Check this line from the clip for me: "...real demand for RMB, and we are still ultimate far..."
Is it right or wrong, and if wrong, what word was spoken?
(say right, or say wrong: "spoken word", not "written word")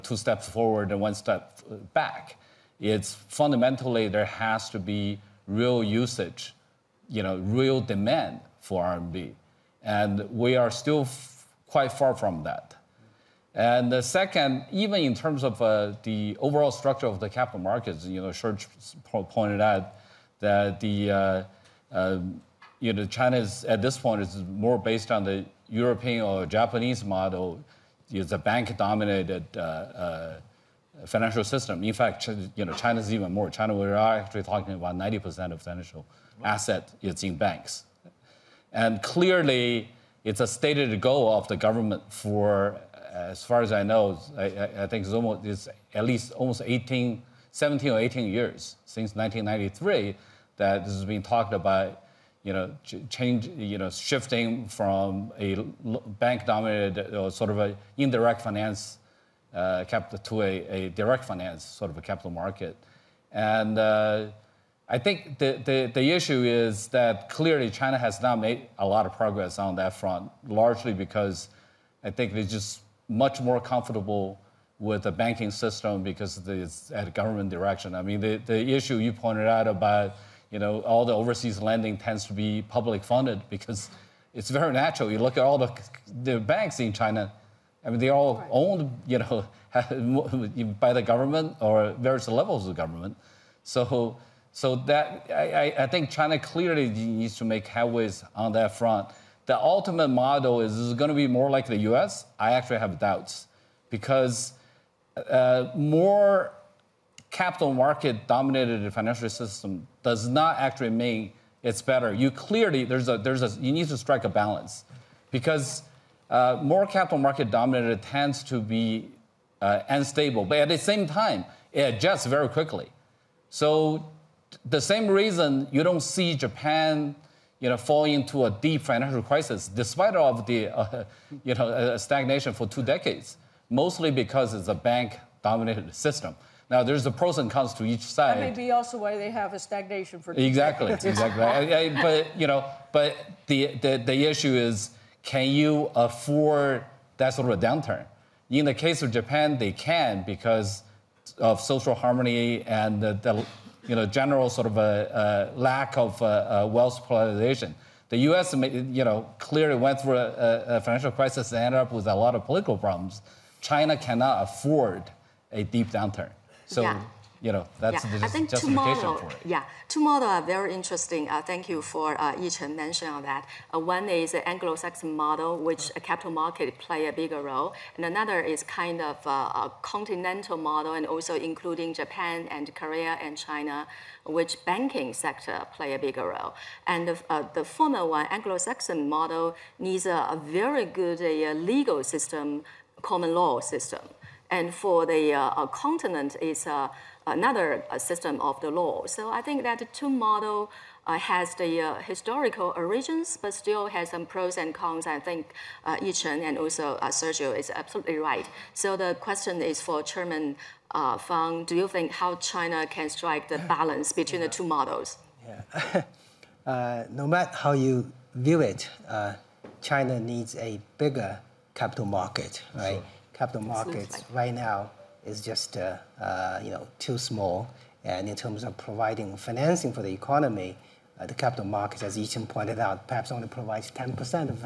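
wrong: "quite", not "ultimate".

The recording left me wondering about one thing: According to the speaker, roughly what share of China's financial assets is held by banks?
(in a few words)
90%.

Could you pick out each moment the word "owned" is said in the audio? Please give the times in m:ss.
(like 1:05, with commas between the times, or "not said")
1:28.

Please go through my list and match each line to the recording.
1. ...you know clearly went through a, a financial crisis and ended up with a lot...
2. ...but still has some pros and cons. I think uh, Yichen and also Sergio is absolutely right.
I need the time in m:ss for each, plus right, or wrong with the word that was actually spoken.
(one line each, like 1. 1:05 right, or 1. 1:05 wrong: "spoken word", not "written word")
1. 2:38 right
2. 3:23 right.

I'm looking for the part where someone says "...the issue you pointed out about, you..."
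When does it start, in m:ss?
1:18.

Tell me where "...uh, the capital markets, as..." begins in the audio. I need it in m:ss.
3:51.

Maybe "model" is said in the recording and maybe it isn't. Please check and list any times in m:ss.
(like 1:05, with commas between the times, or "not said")
0:27, 1:40, 2:50, 2:55, 3:00, 3:09, 3:20, 3:34.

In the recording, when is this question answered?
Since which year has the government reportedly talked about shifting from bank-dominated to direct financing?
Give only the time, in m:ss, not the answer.
0:49.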